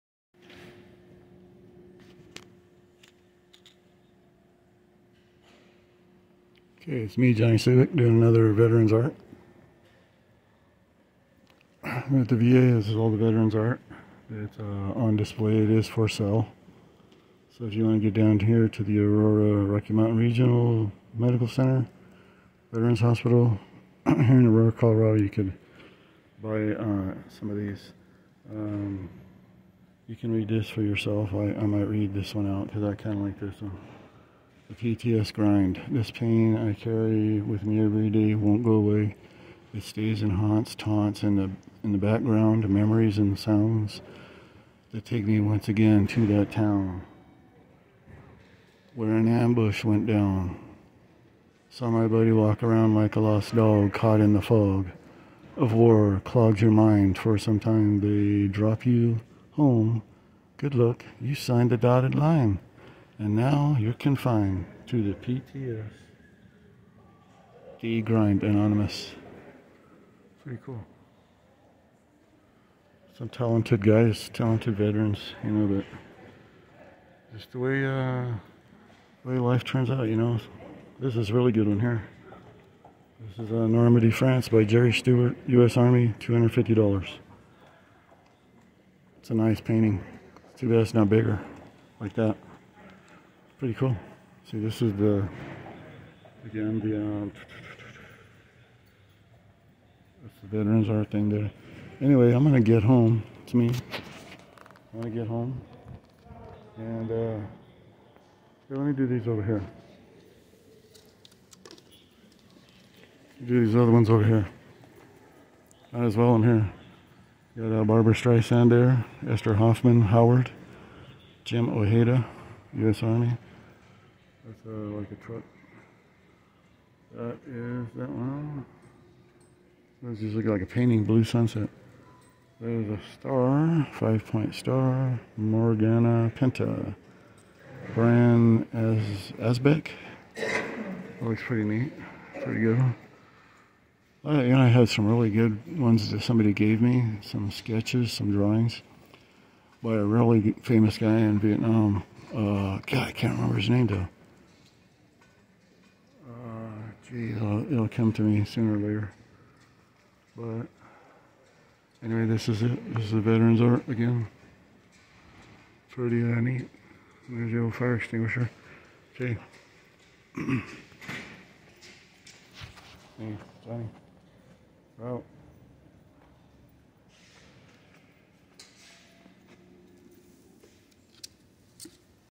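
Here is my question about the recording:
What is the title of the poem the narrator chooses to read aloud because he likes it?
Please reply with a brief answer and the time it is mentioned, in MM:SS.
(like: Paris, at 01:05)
The PTS Grind, at 00:34.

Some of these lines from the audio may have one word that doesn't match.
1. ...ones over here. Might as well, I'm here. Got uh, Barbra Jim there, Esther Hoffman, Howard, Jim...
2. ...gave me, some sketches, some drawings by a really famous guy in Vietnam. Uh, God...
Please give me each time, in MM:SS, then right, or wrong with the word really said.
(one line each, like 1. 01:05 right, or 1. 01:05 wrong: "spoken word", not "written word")
1. 01:53 wrong: "Streisand", not "Jim"
2. 02:26 right.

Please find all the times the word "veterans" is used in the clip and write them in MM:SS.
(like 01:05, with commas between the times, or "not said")
00:08, 00:13, 00:22, 01:14, 01:40, 02:43.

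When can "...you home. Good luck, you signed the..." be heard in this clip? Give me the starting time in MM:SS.
00:58.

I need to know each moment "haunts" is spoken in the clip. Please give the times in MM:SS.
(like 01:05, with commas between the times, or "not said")
00:40.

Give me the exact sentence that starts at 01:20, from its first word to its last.
This is a really good one here.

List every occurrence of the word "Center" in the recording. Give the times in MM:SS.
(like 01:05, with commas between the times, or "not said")
00:21.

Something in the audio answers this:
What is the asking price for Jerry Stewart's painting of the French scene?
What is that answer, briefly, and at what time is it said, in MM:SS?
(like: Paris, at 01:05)
$250, at 01:26.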